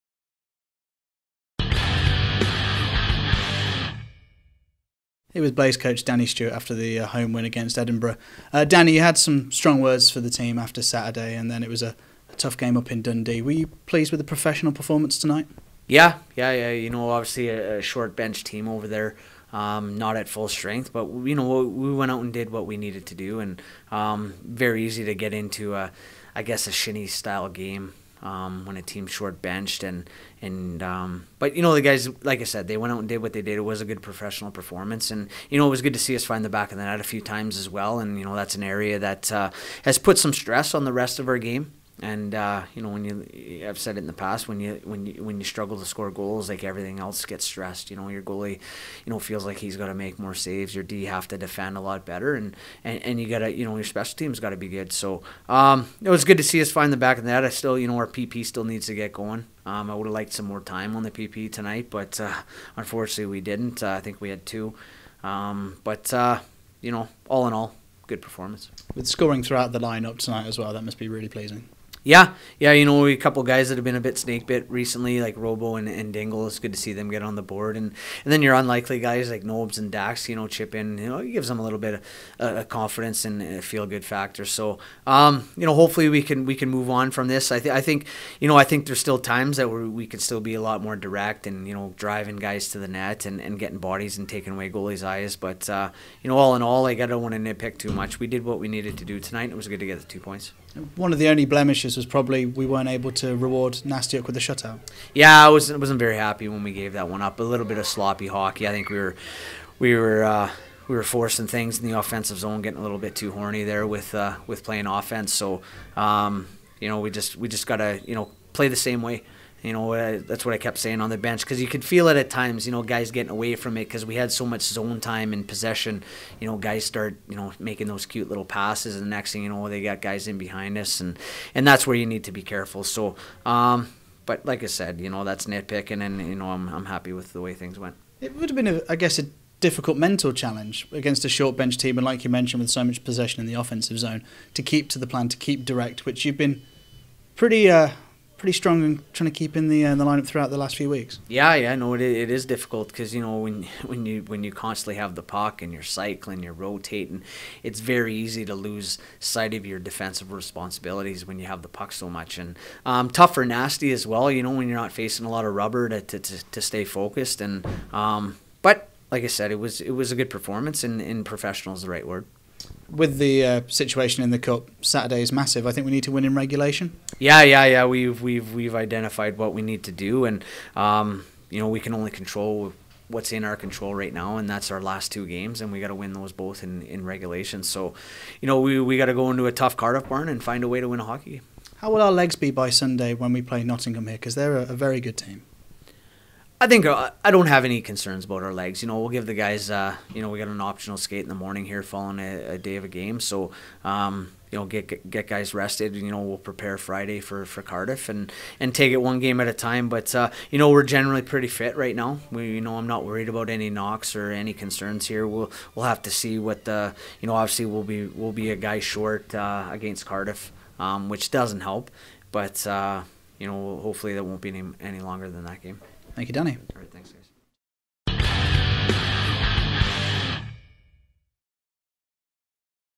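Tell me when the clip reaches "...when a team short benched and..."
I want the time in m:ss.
0:28.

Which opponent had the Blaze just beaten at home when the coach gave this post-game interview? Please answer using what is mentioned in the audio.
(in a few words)
Edinburgh.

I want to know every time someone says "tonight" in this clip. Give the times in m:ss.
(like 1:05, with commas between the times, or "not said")
0:15, 1:01, 1:10, 1:39.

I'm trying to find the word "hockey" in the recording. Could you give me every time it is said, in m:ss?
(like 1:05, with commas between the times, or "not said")
1:48, 3:11.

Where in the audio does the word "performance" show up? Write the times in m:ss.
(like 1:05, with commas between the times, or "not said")
0:14, 0:34, 1:08, 2:50.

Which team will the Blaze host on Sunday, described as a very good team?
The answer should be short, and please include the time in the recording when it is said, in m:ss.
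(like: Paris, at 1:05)
Nottingham, at 3:13.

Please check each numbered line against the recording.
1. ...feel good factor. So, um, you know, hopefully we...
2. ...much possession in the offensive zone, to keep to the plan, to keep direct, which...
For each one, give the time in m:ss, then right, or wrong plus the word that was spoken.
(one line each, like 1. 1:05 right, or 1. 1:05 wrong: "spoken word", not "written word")
1. 1:23 right
2. 2:22 right.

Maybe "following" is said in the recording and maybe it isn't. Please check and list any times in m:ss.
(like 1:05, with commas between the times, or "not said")
3:21.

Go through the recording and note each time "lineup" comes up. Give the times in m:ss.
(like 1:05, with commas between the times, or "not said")
1:09, 2:30.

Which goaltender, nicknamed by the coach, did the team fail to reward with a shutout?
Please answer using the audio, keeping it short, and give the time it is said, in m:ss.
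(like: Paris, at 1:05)
Nastyuk, at 1:43.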